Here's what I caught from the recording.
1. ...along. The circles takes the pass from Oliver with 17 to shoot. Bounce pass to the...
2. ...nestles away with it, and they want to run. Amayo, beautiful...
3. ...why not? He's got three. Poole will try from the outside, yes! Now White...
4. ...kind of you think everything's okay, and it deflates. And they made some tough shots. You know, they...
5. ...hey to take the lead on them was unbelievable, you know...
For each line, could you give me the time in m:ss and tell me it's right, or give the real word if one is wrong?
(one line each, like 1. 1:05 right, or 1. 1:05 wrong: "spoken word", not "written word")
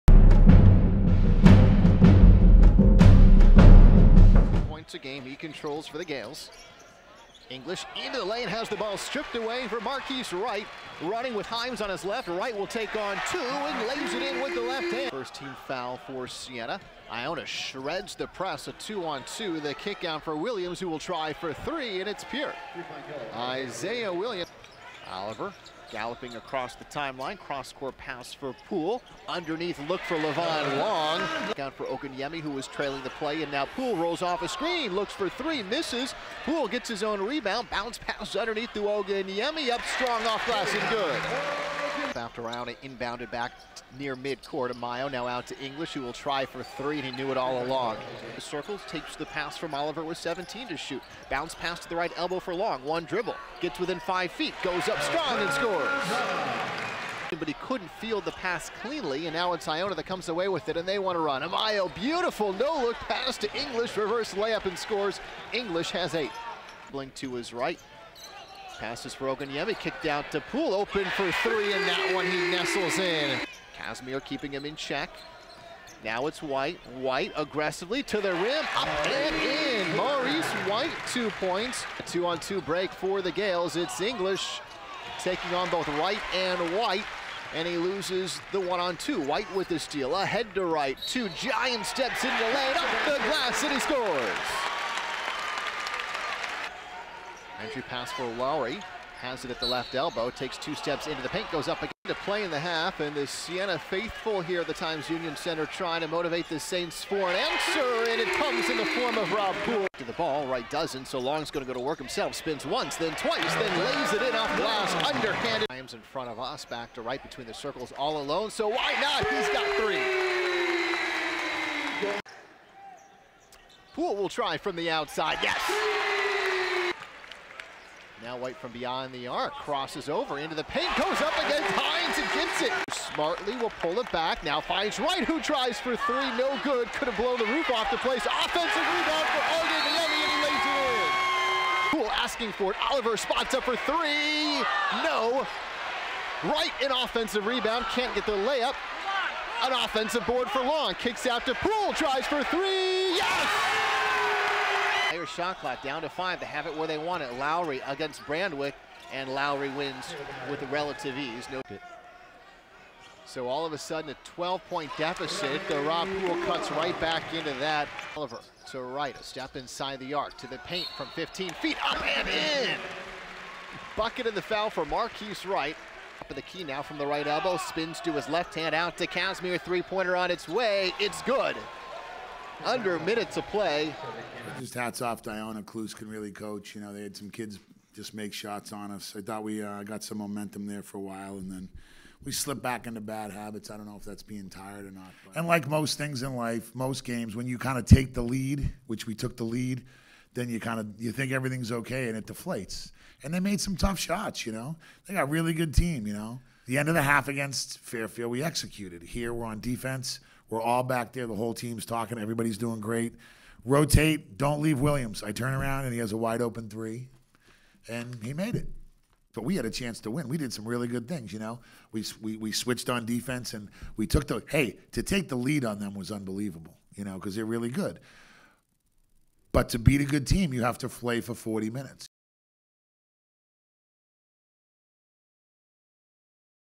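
1. 0:47 right
2. 1:00 wrong: "comes", not "nestles"
3. 1:58 right
4. 3:20 right
5. 3:44 right.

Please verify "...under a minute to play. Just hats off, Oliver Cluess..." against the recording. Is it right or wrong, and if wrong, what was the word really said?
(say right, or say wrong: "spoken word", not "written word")
wrong: "Diana", not "Oliver".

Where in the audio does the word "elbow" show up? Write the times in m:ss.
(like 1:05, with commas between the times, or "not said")
0:52, 1:39, 2:57.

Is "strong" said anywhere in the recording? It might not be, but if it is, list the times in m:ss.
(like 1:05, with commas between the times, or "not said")
0:39, 0:55.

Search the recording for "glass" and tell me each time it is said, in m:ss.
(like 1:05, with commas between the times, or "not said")
0:40, 1:33, 1:54.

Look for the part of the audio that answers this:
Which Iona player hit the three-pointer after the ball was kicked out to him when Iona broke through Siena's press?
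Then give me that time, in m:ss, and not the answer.
0:23.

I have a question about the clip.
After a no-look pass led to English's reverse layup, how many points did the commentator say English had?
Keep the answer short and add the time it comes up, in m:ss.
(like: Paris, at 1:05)
8, at 1:06.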